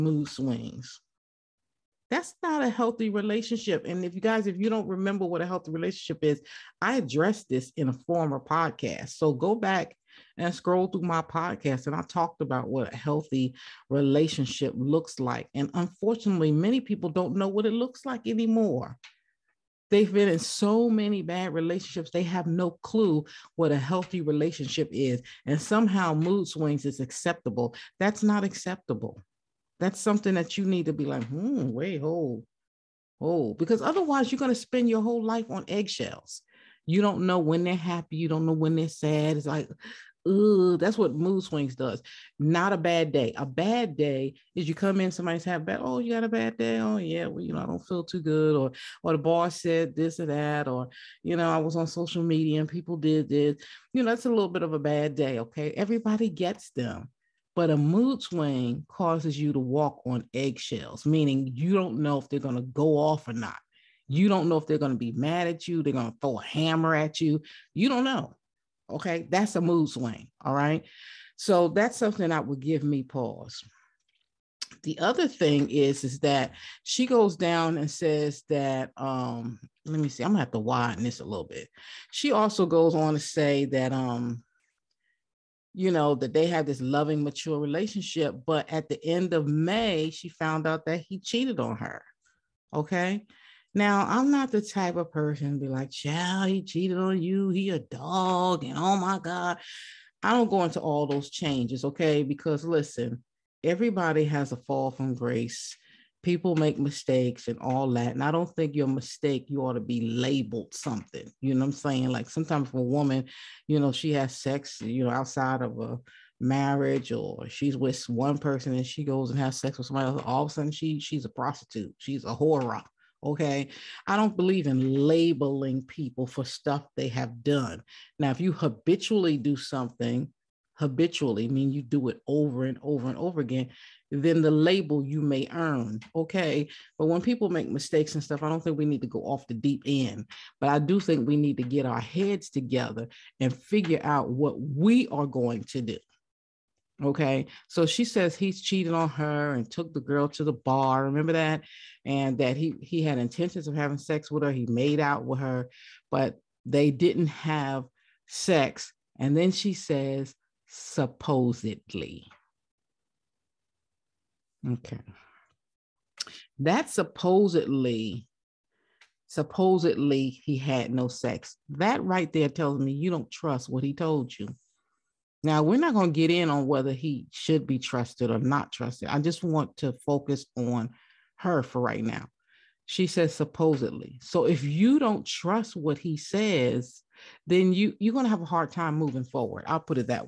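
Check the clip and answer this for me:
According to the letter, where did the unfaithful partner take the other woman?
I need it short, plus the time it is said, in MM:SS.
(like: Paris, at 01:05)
the bar, at 02:30.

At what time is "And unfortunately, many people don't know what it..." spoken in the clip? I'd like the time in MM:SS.
00:15.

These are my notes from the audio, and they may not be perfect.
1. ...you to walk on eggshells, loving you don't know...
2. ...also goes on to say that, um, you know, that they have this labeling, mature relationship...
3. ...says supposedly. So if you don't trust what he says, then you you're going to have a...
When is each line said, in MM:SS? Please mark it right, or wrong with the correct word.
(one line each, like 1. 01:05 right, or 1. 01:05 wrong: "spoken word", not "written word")
1. 00:59 wrong: "meaning", not "loving"
2. 01:22 wrong: "loving", not "labeling"
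3. 03:03 right.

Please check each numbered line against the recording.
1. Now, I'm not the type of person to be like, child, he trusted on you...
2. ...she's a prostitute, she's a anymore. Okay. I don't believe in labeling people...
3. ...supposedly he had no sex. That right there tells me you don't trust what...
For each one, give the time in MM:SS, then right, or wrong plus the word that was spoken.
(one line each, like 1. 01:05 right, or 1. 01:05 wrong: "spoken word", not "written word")
1. 01:33 wrong: "cheated", not "trusted"
2. 02:00 wrong: "whore", not "anymore"
3. 02:49 right.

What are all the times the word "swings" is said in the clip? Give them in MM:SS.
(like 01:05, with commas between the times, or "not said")
00:00, 00:26, 00:41, 00:58, 01:09.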